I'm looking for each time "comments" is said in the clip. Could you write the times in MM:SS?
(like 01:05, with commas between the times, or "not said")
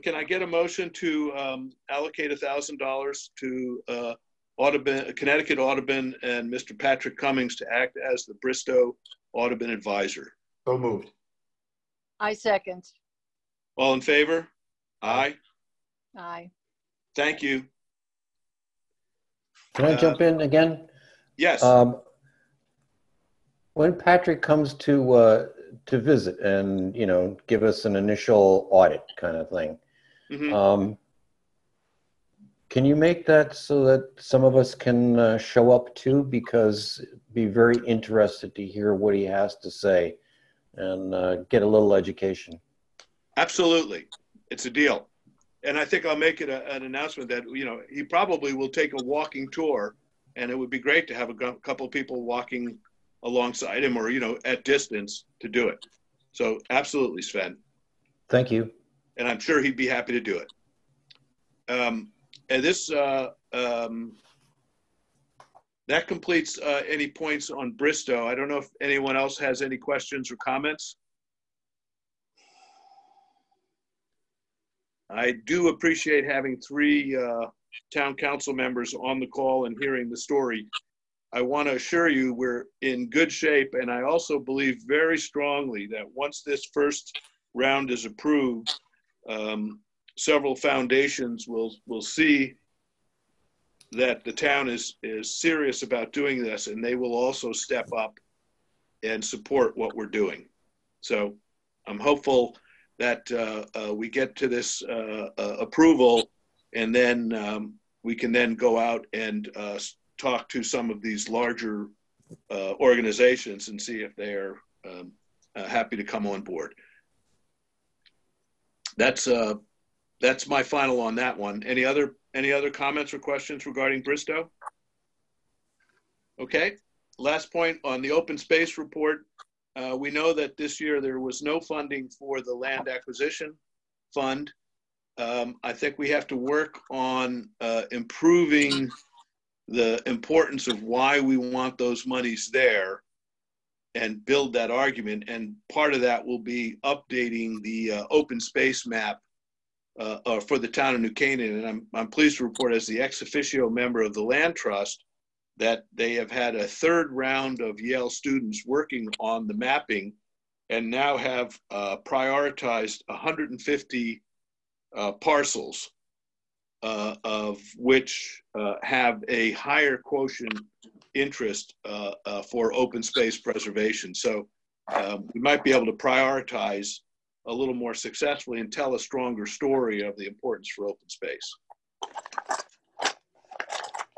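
01:10, 02:02.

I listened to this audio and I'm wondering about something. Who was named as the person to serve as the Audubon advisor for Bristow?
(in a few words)
Patrick Comins.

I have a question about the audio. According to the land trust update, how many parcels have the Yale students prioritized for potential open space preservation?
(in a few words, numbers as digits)
150.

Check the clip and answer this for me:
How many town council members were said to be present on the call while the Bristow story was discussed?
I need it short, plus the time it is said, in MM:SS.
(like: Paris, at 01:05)
3, at 01:16.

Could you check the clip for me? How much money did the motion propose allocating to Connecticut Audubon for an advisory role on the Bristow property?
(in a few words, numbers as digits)
$1,000.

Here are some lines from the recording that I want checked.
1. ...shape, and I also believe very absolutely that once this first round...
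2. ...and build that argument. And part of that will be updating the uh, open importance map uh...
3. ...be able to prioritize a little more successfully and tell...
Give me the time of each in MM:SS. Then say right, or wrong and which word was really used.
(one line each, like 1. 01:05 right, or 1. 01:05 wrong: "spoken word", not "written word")
1. 01:23 wrong: "strongly", not "absolutely"
2. 02:23 wrong: "space", not "importance"
3. 02:55 right.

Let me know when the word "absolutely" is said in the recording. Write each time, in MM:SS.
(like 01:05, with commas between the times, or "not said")
00:43, 00:56.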